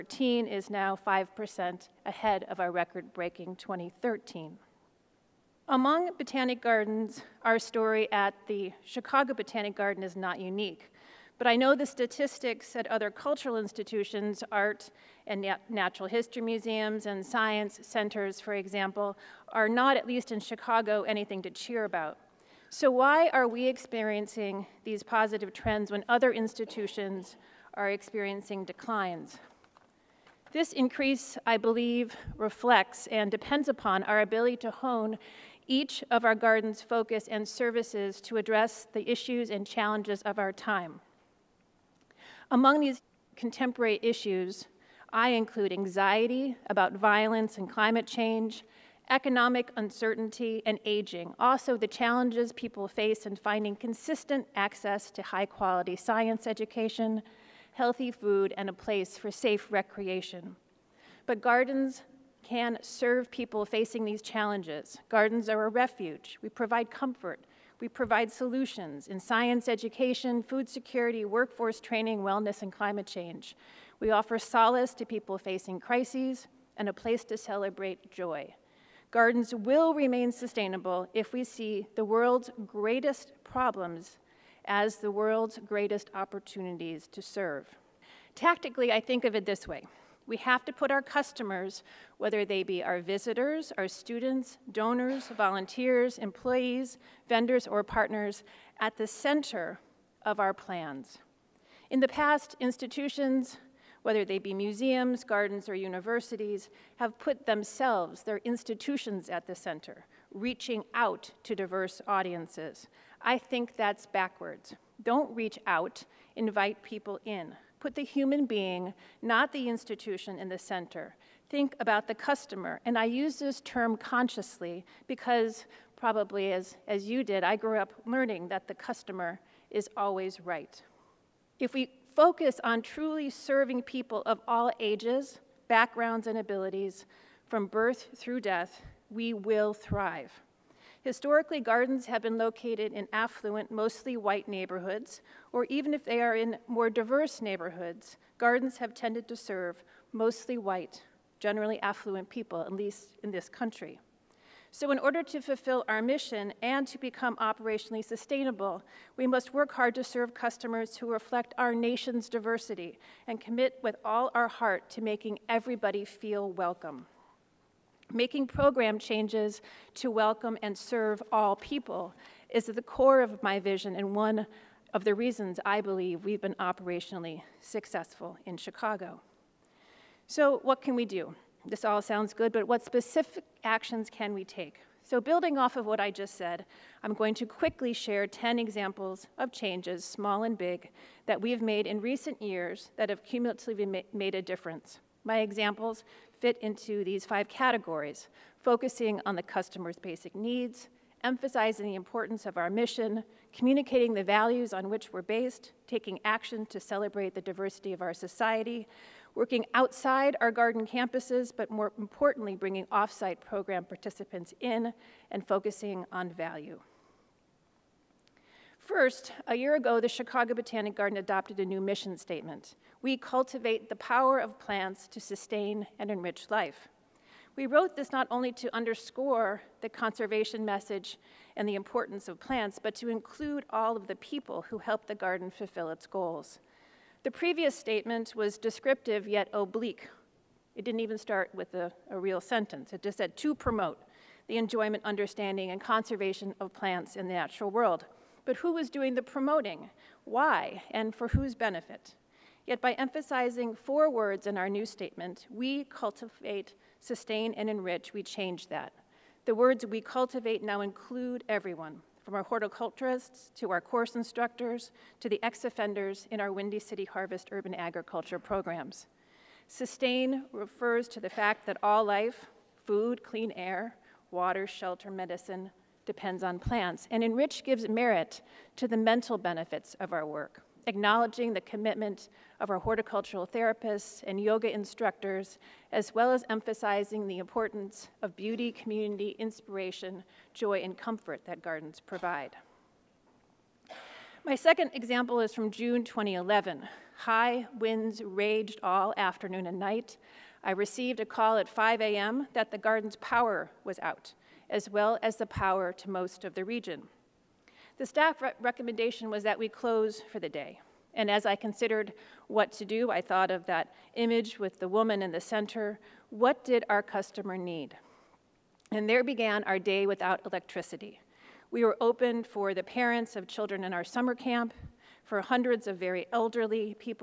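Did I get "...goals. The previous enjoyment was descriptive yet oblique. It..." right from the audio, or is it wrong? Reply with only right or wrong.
wrong.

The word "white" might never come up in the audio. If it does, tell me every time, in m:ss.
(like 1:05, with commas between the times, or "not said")
2:24, 2:30.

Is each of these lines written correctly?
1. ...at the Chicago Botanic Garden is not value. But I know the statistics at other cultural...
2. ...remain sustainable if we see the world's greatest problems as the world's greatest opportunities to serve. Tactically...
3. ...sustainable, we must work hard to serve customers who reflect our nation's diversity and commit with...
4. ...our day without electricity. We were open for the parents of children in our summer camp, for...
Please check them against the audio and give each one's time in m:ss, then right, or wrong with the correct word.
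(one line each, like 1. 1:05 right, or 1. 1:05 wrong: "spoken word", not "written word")
1. 0:08 wrong: "unique", not "value"
2. 1:19 right
3. 2:38 right
4. 5:19 right.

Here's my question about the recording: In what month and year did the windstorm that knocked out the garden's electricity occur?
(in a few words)
June 2011.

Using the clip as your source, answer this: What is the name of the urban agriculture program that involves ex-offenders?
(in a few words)
Windy City Harvest.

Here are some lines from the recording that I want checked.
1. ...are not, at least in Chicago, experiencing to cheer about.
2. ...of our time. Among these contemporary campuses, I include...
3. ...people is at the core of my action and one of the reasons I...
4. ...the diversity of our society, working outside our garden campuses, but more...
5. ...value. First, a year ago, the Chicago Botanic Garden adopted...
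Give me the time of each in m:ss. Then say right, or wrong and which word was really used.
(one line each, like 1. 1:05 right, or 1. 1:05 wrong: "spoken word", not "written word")
1. 0:19 wrong: "anything", not "experiencing"
2. 0:40 wrong: "issues", not "campuses"
3. 2:51 wrong: "vision", not "action"
4. 3:27 right
5. 3:36 right.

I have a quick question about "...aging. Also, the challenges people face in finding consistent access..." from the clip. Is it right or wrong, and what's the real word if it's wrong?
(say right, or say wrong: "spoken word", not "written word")
right.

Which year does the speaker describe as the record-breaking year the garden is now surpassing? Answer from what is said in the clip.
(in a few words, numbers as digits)
2013.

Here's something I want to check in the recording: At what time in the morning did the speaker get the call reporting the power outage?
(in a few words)
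5 a.m.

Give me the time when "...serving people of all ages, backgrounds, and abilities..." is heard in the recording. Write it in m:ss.
2:13.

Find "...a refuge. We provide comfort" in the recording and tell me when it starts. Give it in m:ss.
1:05.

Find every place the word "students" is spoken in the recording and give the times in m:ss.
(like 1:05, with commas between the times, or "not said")
1:33.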